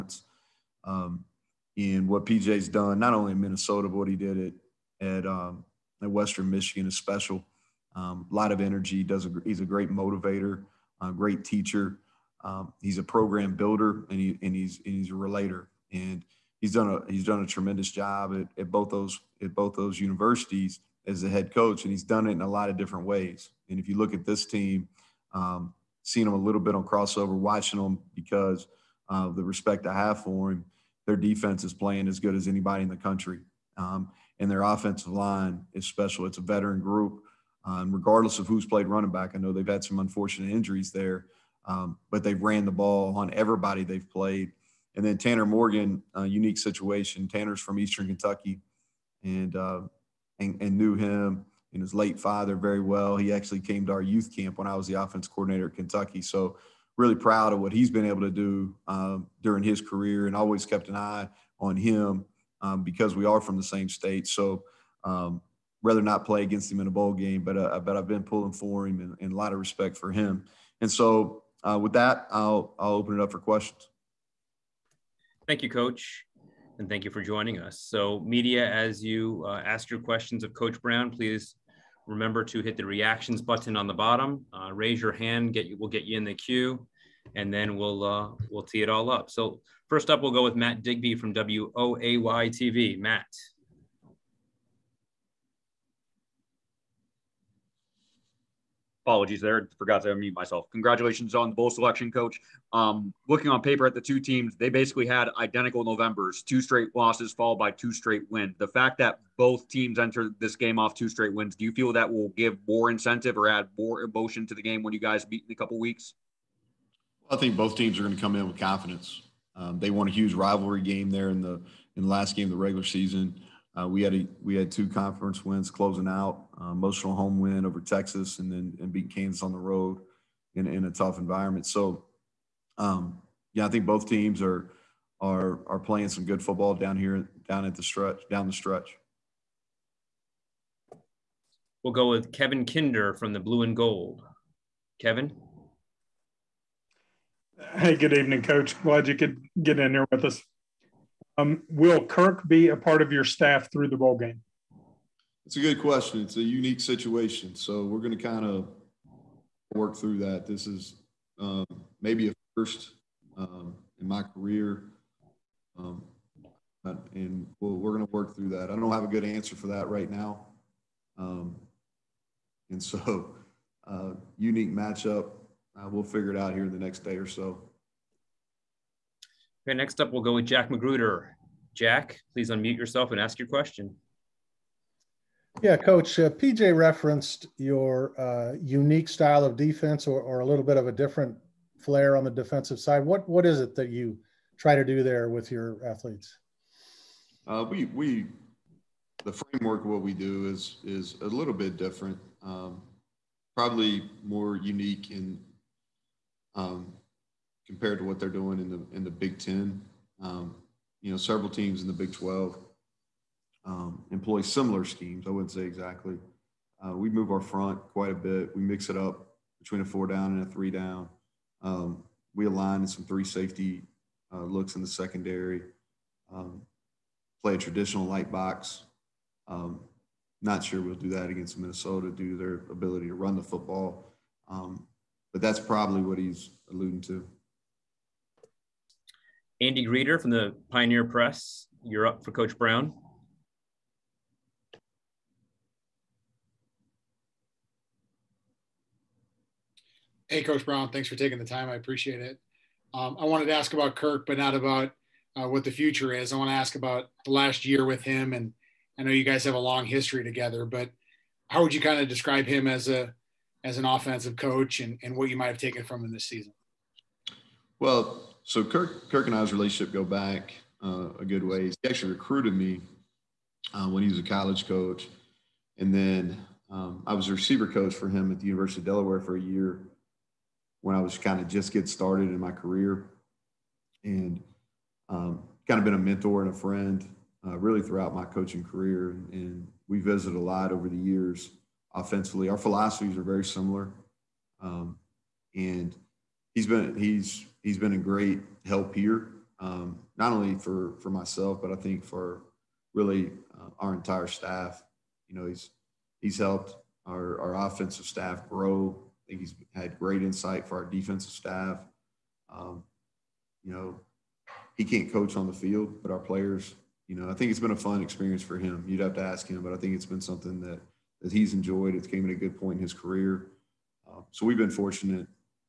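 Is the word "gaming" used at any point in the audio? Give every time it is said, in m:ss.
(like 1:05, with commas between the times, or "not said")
not said.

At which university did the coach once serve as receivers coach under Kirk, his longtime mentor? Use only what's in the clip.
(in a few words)
University of Delaware.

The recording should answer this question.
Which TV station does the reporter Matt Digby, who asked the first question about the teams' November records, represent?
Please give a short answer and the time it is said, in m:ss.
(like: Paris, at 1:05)
WOAY-TV, at 1:31.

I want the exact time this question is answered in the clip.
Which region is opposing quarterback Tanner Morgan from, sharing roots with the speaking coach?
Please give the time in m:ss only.
0:47.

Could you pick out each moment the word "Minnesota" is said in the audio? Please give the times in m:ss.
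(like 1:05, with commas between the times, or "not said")
0:03, 3:51.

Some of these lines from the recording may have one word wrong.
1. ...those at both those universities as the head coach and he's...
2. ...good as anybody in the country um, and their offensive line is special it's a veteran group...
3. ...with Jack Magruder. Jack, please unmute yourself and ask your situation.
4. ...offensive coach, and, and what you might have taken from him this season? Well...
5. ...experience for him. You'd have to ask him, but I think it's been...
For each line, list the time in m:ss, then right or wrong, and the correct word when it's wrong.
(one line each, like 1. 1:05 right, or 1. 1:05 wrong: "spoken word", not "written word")
1. 0:18 right
2. 0:32 right
3. 3:00 wrong: "question", not "situation"
4. 4:23 right
5. 5:17 right.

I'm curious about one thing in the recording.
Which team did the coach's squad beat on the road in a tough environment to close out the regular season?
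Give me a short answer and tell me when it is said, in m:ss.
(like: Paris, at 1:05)
Kansas, at 2:09.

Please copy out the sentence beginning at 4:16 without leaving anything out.
I want to ask about the last year with him, and I know you guys have a long history together.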